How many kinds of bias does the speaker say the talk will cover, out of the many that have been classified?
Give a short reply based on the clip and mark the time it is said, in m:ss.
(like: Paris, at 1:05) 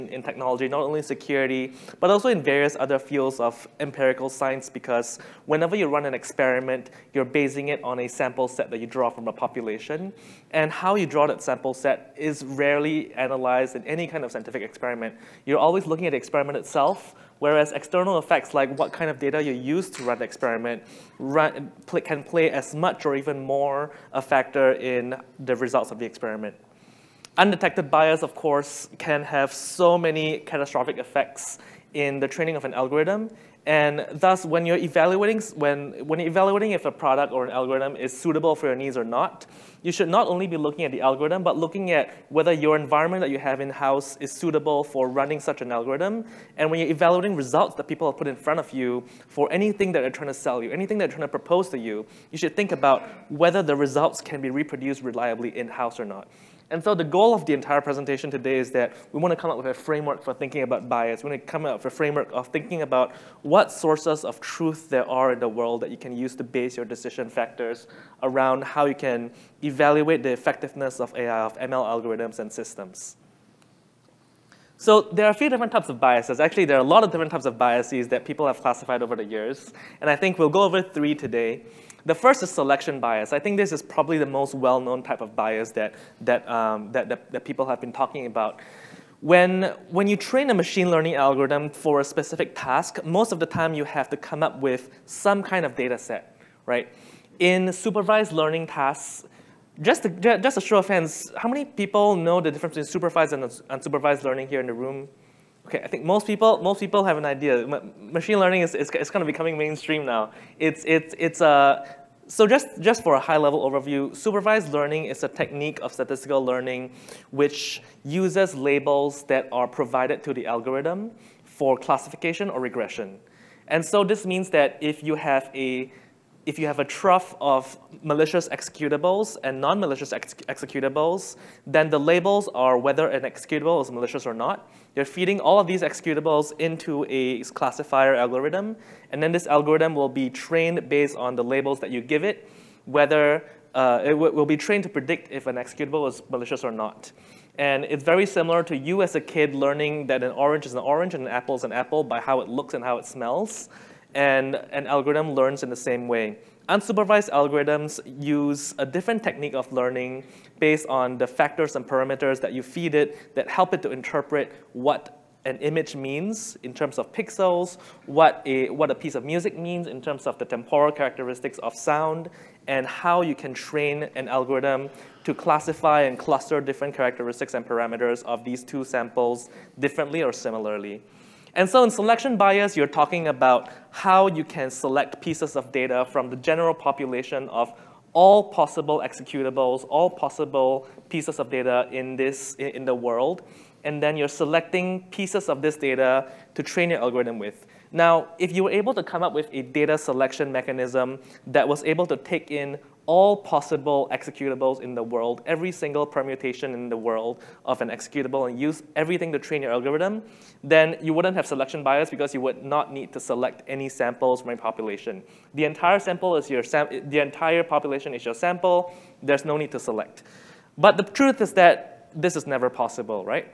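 3, at 1:20.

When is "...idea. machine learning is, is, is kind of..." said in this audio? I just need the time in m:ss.
1:47.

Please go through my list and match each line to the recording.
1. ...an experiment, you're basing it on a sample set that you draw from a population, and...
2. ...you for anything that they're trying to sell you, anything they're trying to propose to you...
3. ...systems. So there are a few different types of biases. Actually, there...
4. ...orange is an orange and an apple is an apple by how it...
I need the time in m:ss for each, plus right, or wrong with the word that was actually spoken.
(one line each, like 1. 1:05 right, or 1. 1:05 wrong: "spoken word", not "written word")
1. 0:06 right
2. 0:48 right
3. 1:12 right
4. 2:30 right.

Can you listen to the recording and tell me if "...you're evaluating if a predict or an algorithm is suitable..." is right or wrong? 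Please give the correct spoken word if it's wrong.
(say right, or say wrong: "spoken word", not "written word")
wrong: "product", not "predict".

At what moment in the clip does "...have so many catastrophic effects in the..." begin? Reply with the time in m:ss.
0:29.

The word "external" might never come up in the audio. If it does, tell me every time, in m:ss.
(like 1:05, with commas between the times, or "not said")
0:17.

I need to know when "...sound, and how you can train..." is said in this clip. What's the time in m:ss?
2:51.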